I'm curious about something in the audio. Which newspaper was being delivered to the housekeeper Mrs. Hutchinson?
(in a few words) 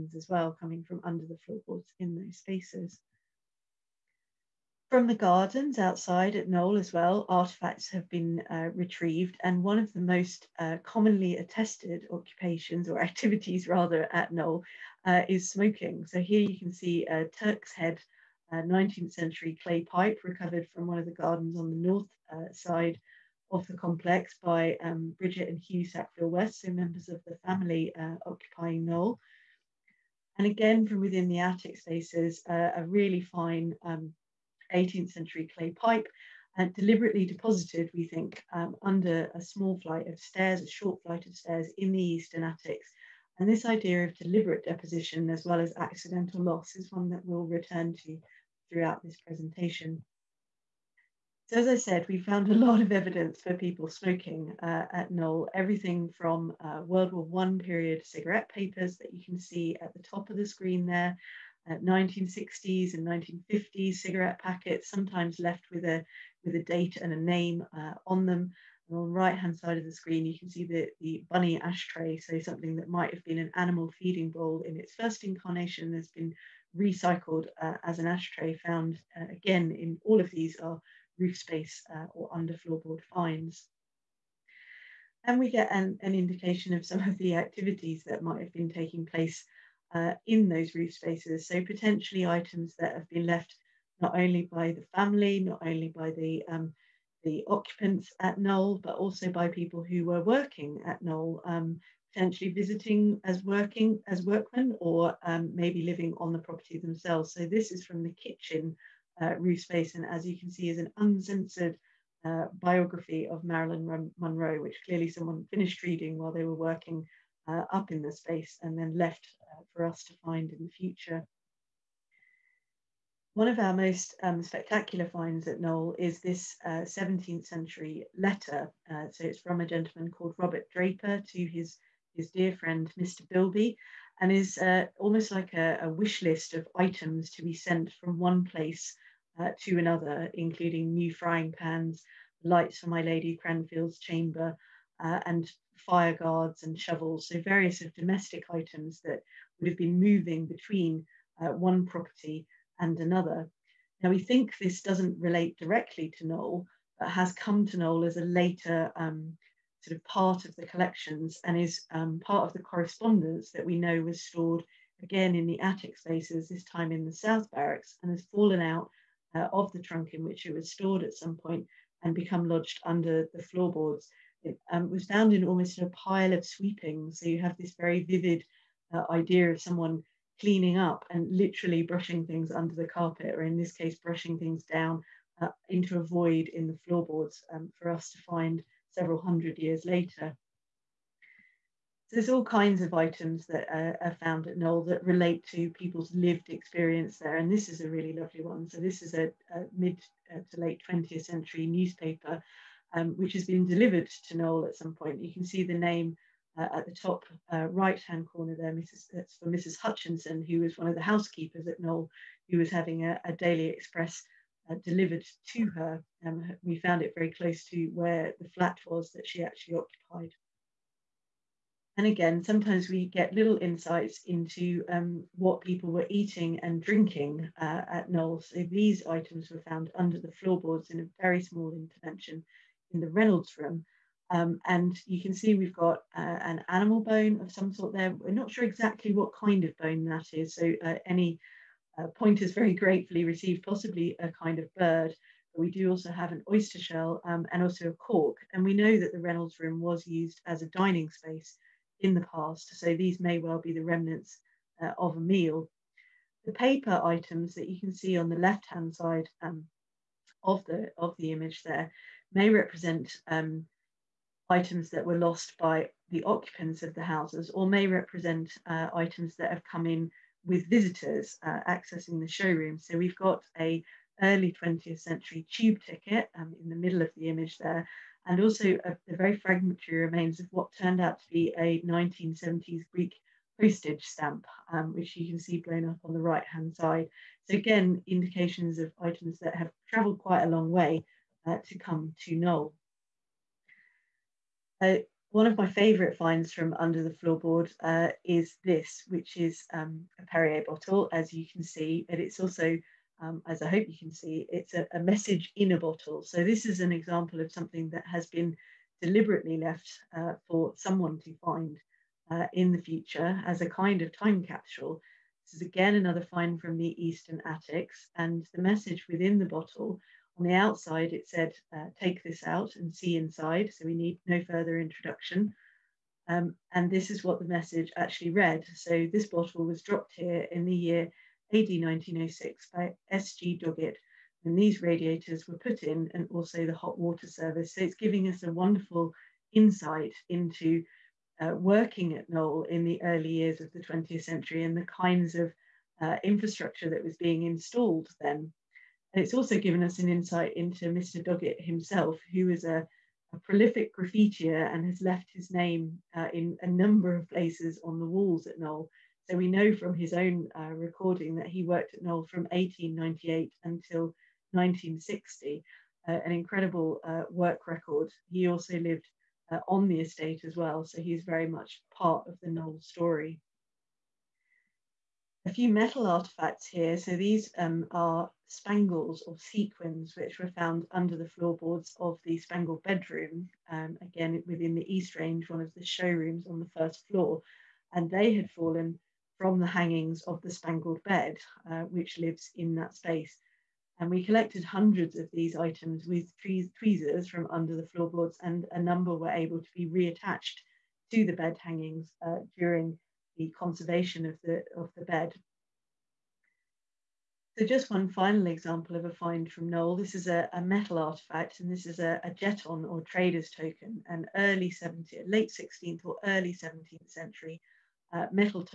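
Daily Express.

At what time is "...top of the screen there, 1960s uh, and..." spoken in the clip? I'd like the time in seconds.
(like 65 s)
60 s.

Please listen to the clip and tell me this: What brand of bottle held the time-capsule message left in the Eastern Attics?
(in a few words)
Perrier.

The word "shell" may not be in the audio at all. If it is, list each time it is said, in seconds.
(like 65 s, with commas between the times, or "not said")
246 s.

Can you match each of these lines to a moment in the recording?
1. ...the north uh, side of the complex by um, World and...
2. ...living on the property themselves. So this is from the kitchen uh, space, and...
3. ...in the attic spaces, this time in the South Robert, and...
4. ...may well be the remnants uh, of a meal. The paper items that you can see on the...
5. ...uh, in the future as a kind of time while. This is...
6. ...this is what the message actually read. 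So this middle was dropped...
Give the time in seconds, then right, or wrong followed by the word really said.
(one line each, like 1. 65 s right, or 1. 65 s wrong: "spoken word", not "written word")
1. 21 s wrong: "Bridget", not "World"
2. 105 s right
3. 165 s wrong: "Barracks", not "Robert"
4. 253 s right
5. 312 s wrong: "capsule", not "while"
6. 326 s wrong: "bottle", not "middle".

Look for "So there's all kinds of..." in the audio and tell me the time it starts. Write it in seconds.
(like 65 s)
192 s.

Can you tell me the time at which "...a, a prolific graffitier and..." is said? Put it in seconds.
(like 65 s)
352 s.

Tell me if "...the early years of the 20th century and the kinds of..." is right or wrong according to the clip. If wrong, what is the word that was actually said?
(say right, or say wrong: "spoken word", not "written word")
right.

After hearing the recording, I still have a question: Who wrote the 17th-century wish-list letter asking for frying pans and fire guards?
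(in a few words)
Robert Draper.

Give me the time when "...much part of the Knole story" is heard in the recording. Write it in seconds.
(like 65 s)
371 s.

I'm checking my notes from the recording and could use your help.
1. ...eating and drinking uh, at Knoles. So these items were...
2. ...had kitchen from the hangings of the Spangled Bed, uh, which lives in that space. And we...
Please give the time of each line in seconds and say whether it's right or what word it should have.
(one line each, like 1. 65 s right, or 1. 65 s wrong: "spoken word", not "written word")
1. 226 s right
2. 388 s wrong: "fallen", not "kitchen".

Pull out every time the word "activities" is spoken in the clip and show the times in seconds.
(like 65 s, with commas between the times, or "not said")
13 s, 87 s.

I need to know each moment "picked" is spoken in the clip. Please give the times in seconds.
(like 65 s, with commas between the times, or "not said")
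not said.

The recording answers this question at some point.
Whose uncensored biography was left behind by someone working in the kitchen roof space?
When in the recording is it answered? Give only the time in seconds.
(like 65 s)
113 s.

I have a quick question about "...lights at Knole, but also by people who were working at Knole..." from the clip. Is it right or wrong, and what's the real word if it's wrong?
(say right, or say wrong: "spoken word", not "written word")
wrong: "occupants", not "lights".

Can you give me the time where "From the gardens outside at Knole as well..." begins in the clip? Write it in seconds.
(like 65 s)
4 s.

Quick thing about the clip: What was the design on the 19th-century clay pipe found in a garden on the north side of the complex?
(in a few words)
Turk's head.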